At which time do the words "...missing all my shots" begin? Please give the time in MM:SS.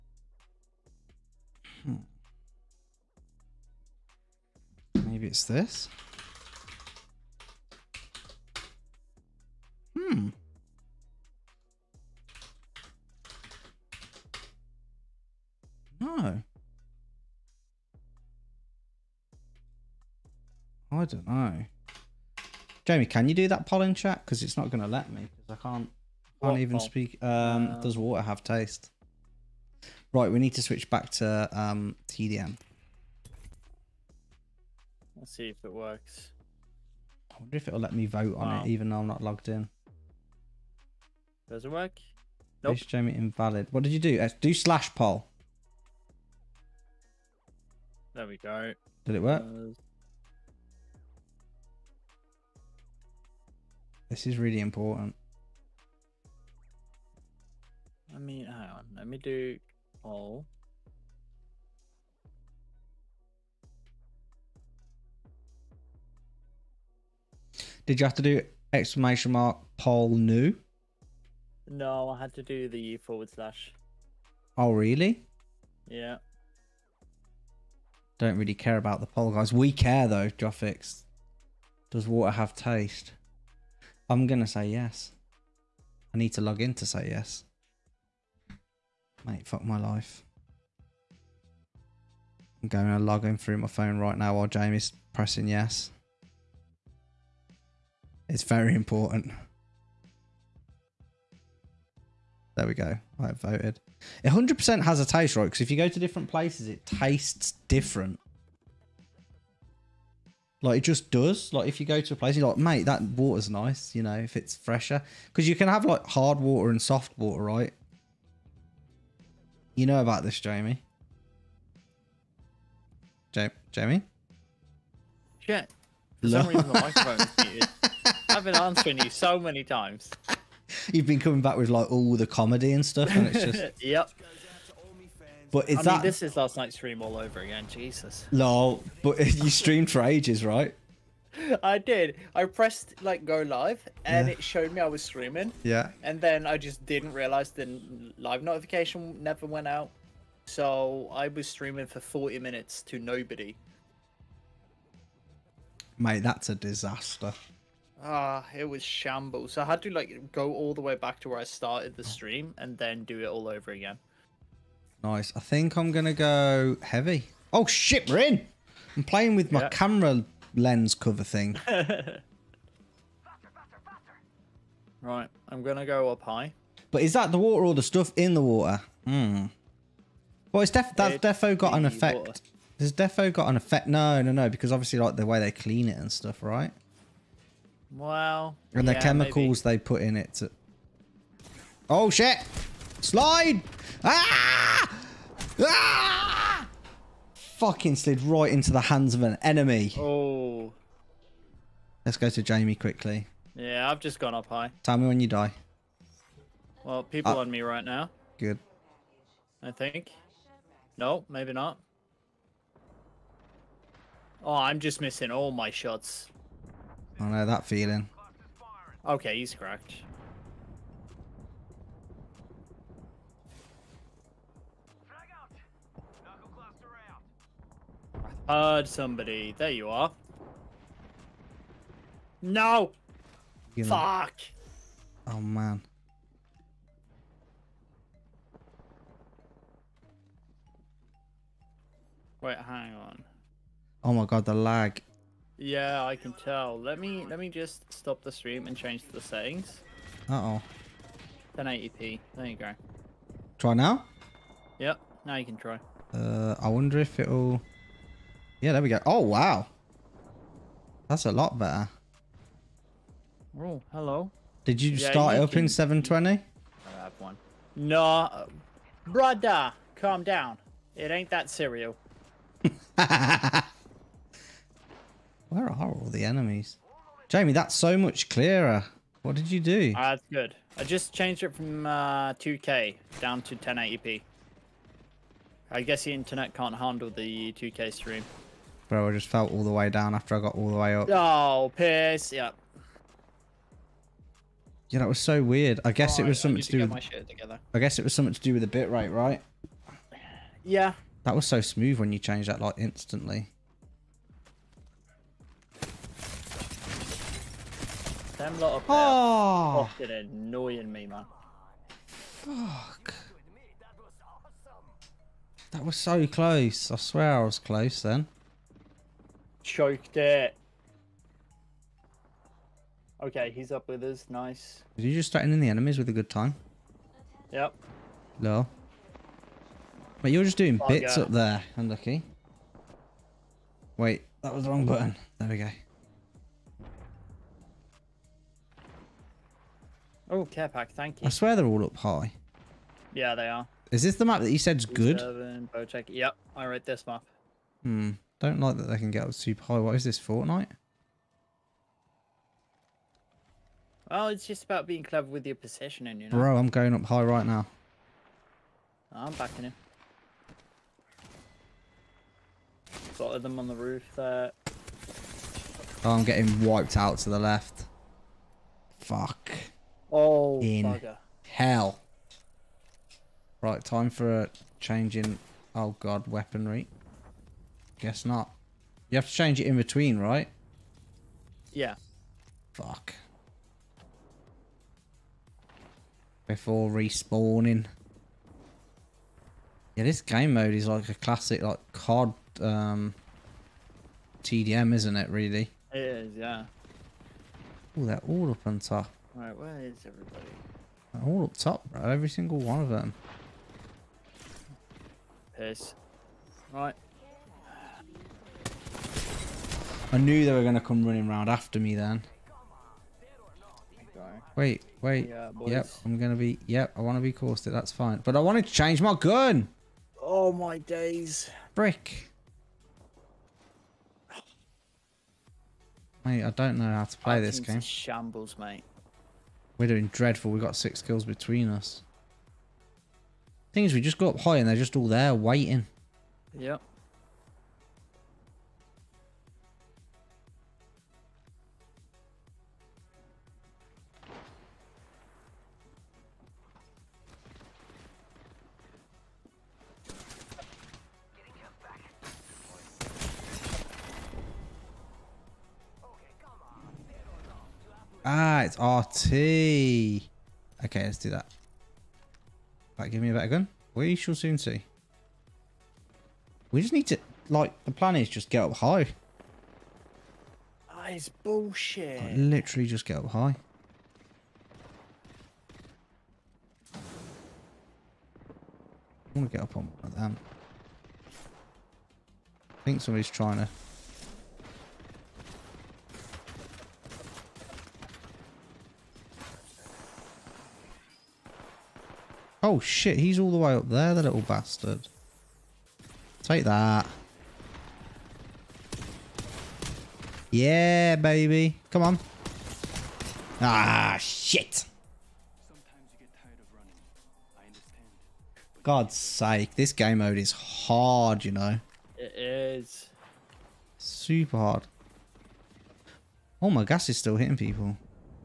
03:34.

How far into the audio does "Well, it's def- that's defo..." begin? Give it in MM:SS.
03:00.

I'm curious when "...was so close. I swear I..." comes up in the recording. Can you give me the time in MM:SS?
05:15.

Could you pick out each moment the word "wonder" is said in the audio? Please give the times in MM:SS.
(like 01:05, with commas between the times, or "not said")
00:37, 04:16.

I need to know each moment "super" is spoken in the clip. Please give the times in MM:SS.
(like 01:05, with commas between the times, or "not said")
05:49, 08:33.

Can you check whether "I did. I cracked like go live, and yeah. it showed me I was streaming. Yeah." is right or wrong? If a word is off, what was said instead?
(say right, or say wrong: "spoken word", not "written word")
wrong: "pressed", not "cracked".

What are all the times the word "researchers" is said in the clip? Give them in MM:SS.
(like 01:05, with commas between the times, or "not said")
not said.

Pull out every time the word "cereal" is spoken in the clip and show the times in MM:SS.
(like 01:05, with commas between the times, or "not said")
04:31.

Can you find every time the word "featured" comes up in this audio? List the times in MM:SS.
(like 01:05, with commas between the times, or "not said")
not said.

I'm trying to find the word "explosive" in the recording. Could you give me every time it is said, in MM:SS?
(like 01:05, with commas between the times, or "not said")
not said.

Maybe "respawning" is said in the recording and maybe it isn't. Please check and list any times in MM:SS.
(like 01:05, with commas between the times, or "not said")
06:26.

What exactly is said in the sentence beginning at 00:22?
Jamie, can you do that pollen chat?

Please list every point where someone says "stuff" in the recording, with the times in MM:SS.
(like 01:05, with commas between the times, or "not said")
02:12, 02:57, 03:06.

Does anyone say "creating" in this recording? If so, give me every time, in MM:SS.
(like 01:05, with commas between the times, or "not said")
not said.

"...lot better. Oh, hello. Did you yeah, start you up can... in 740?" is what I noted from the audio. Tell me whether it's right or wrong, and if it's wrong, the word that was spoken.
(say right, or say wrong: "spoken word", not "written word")
wrong: "720", not "740".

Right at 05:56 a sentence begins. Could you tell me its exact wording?
Bro, I'm going up high right now.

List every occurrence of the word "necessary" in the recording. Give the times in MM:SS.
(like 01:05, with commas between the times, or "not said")
not said.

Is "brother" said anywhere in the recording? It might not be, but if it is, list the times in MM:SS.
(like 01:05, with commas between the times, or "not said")
04:29.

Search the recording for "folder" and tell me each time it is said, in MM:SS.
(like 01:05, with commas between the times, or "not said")
not said.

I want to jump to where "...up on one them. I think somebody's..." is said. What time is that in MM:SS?
07:59.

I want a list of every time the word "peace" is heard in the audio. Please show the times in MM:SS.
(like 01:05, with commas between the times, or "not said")
not said.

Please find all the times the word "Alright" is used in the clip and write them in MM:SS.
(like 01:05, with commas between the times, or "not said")
06:39.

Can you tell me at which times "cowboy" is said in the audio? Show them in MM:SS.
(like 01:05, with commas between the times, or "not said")
not said.